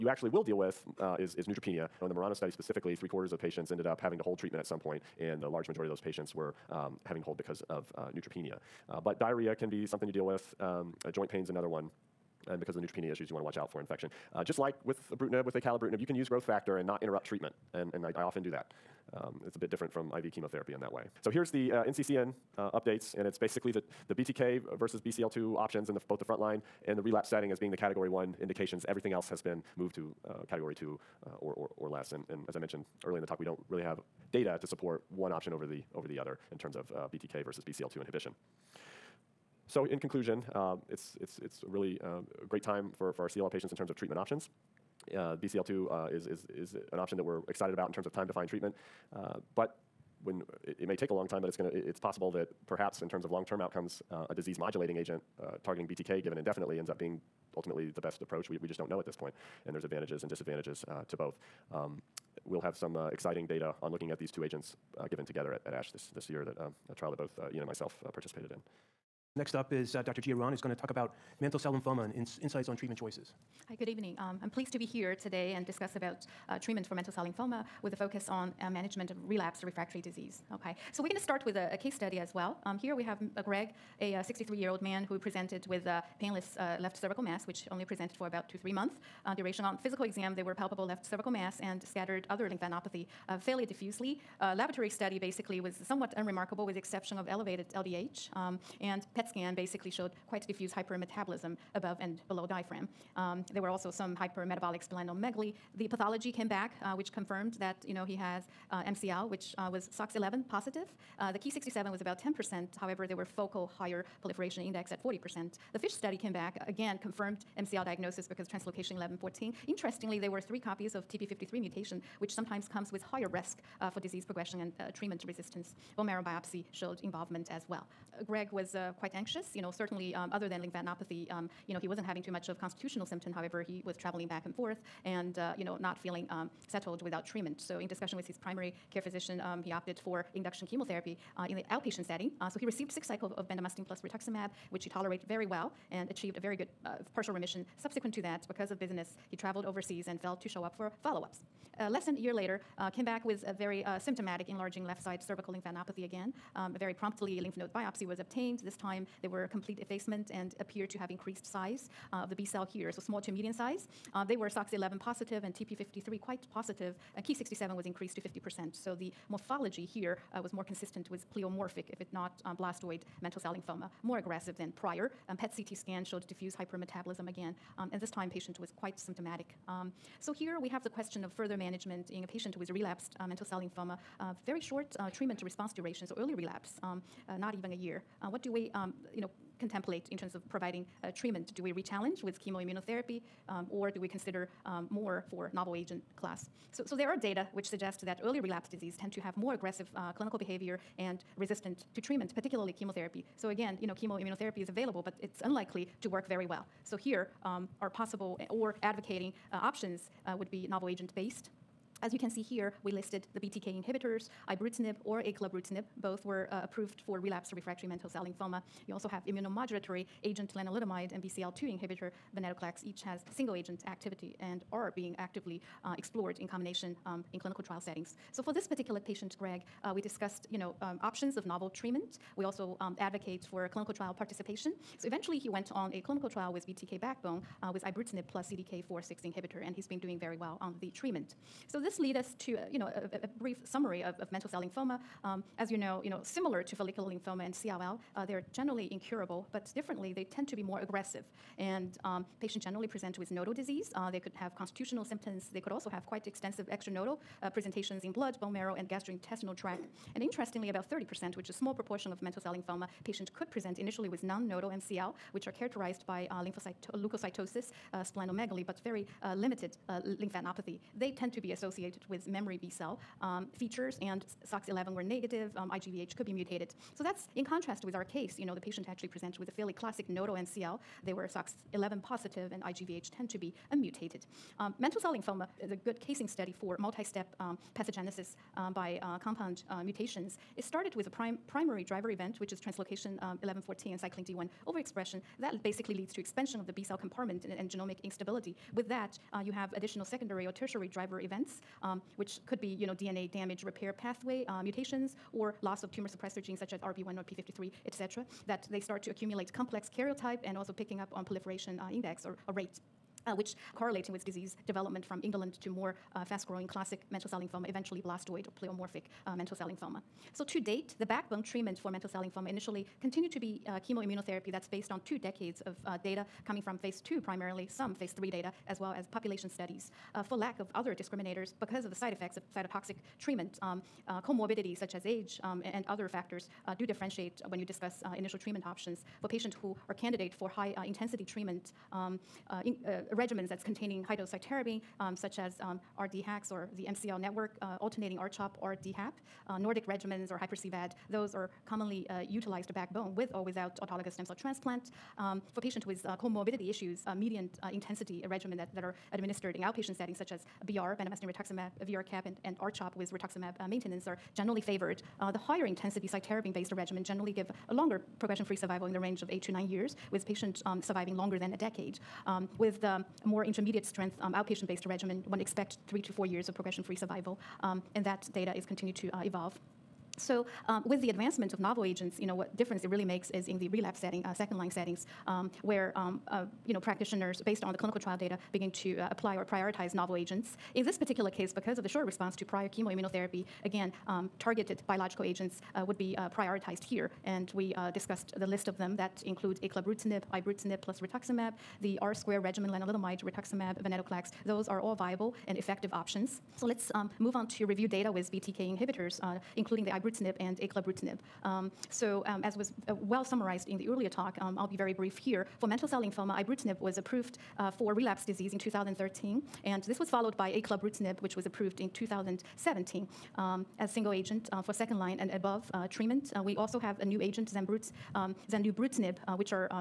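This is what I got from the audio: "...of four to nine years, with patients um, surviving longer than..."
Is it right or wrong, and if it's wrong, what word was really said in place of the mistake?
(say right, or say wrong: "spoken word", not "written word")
wrong: "eight", not "four".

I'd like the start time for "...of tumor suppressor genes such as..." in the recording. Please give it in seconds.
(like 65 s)
305 s.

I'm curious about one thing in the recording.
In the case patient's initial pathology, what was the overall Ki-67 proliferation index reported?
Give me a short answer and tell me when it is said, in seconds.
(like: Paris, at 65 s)
10%, at 112 s.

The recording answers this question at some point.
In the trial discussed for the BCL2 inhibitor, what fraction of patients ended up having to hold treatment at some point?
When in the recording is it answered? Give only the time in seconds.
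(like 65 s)
2 s.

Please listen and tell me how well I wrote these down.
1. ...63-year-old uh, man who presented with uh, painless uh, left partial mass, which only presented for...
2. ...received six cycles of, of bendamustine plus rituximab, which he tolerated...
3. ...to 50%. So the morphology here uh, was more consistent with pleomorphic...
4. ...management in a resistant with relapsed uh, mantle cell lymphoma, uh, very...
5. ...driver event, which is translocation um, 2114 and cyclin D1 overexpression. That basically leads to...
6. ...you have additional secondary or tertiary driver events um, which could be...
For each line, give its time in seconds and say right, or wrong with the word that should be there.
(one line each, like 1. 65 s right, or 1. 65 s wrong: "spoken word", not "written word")
1. 84 s wrong: "cervical", not "partial"
2. 142 s right
3. 168 s right
4. 181 s wrong: "patient", not "resistant"
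5. 291 s wrong: "1114", not "2114"
6. 299 s right.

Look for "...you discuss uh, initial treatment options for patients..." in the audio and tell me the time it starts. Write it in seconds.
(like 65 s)
337 s.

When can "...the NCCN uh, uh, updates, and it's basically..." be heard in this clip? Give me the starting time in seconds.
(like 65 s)
21 s.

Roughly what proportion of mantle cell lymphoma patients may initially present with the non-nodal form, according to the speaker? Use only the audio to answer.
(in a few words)
30%.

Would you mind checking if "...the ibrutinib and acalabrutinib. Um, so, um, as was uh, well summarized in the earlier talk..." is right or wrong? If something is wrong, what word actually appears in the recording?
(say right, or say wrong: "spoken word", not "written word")
right.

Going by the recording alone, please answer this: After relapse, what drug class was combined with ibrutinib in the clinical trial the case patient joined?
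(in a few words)
CDK4-6 inhibitor.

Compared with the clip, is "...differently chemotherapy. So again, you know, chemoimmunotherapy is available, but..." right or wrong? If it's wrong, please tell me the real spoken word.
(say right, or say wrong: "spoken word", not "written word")
wrong: "particularly", not "differently".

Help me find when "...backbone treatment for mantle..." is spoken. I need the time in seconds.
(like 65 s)
321 s.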